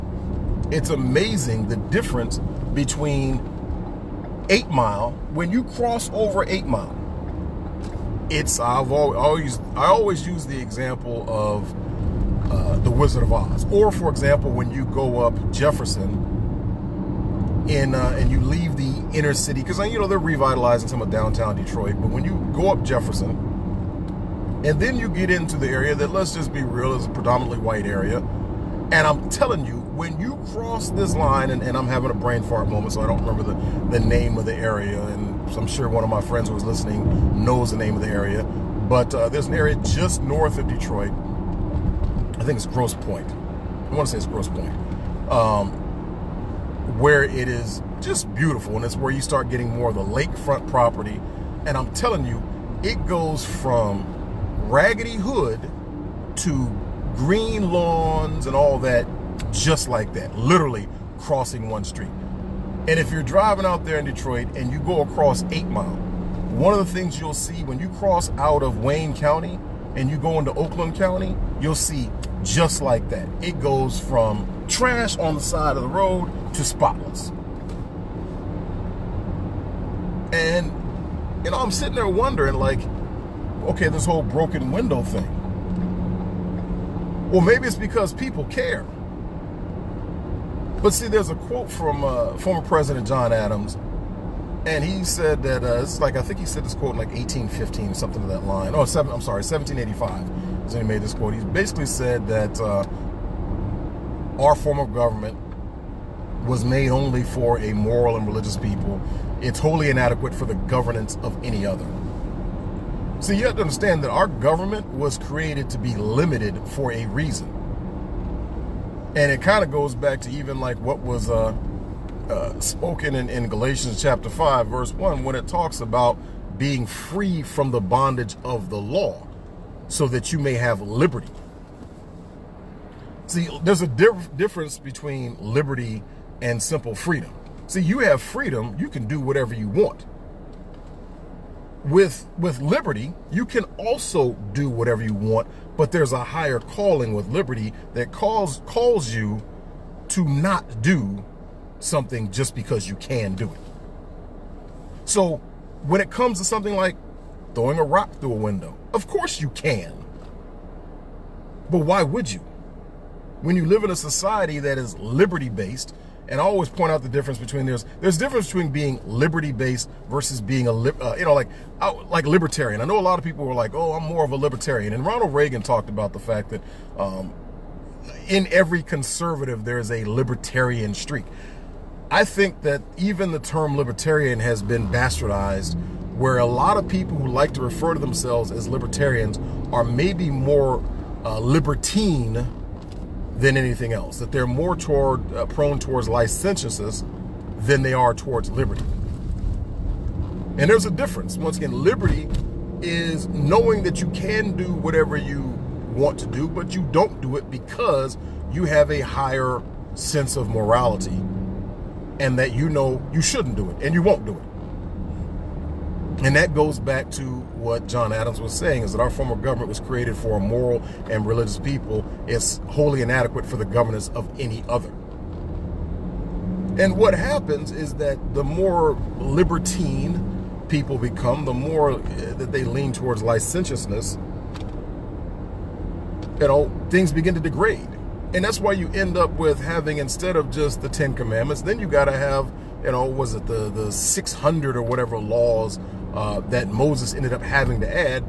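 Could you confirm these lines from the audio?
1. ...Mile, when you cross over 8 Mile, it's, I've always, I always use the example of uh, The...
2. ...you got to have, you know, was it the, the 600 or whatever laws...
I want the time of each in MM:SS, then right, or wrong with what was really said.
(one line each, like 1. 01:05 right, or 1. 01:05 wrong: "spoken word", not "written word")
1. 00:04 right
2. 04:01 right.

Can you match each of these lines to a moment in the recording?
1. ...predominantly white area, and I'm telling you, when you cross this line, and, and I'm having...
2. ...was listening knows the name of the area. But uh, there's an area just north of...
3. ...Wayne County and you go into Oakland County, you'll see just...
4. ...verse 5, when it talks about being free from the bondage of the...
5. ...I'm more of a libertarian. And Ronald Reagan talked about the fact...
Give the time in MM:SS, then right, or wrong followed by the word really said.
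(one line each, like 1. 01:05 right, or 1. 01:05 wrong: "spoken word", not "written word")
1. 00:27 right
2. 00:36 right
3. 01:08 right
4. 02:04 wrong: "1", not "5"
5. 02:53 right.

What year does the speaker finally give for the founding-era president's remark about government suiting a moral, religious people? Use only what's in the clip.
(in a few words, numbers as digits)
1785.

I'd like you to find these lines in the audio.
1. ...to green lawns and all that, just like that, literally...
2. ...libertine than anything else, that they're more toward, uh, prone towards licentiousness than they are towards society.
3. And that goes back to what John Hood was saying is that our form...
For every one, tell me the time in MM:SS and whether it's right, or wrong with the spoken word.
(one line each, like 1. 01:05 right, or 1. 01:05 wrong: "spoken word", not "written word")
1. 00:56 right
2. 03:11 wrong: "liberty", not "society"
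3. 03:36 wrong: "Adams", not "Hood".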